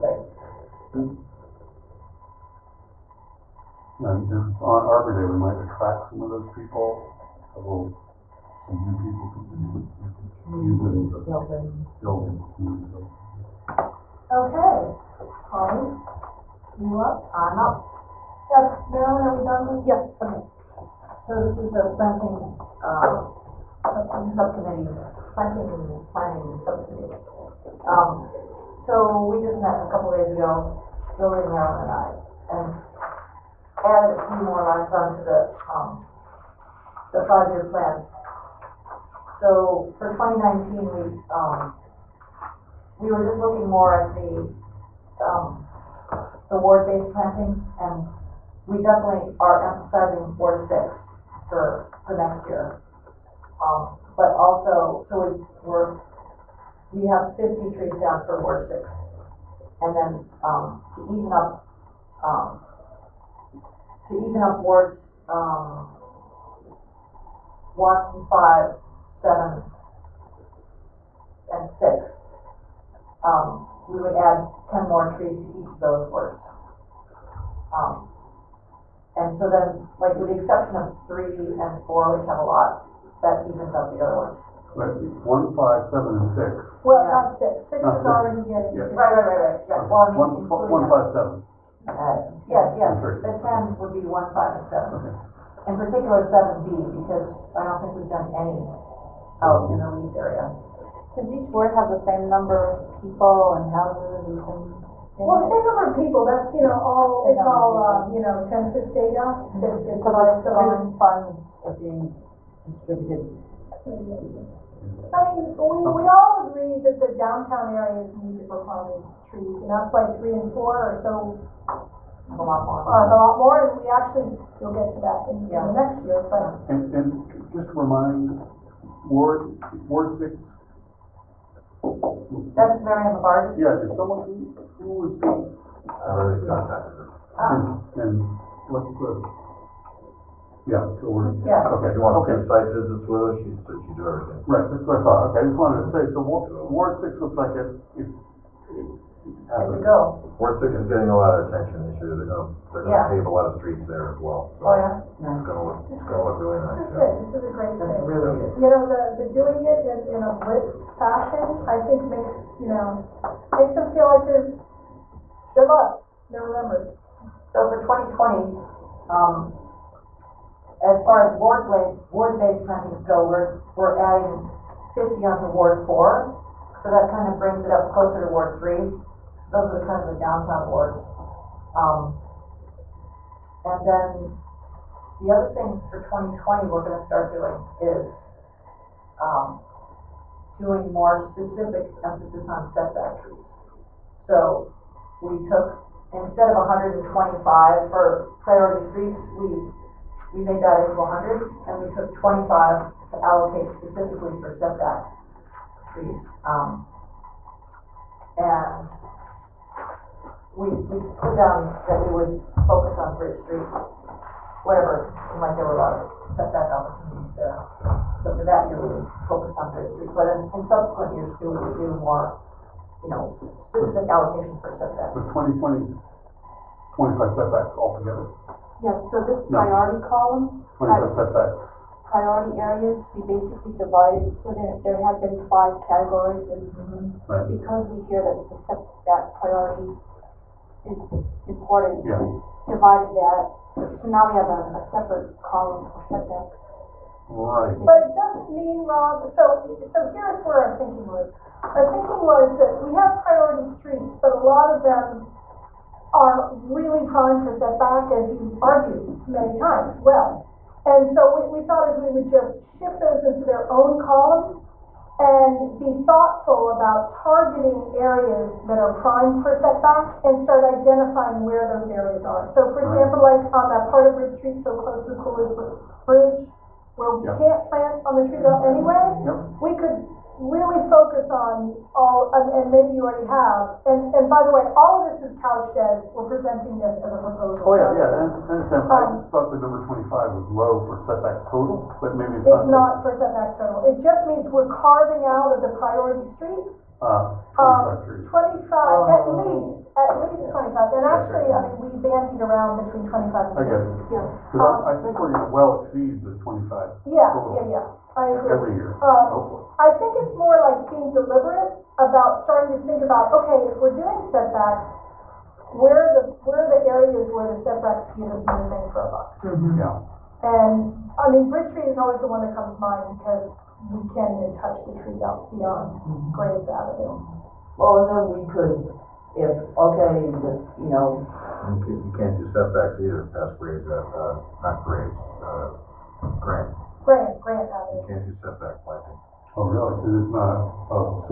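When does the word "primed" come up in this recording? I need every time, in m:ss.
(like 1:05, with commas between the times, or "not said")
4:17, 4:28.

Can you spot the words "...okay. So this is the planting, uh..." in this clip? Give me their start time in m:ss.
0:20.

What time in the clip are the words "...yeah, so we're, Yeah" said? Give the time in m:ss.
2:20.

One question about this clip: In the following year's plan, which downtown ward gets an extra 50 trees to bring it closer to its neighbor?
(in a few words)
Ward 4.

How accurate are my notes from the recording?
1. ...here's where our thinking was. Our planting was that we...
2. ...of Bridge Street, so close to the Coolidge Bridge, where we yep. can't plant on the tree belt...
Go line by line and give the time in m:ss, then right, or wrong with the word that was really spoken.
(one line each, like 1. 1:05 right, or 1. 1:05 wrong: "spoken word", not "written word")
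1. 4:10 wrong: "thinking", not "planting"
2. 4:34 right.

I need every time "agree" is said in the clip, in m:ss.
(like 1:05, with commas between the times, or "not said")
1:56, 5:08.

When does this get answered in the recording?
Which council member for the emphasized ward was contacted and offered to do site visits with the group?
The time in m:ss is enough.
2:12.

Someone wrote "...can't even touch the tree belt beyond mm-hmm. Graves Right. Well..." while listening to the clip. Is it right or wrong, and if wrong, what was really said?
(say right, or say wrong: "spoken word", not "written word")
wrong: "Avenue", not "Right".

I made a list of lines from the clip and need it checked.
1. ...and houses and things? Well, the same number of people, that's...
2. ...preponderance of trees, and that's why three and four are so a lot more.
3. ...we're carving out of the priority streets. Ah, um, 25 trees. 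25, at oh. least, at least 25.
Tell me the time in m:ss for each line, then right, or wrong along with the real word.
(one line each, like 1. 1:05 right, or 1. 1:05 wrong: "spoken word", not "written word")
1. 1:43 right
2. 1:58 right
3. 4:54 right.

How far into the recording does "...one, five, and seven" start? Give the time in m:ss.
1:34.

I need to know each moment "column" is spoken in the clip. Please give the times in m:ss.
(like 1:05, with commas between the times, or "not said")
3:50, 4:05, 4:24.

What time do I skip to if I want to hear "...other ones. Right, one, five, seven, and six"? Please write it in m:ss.
1:24.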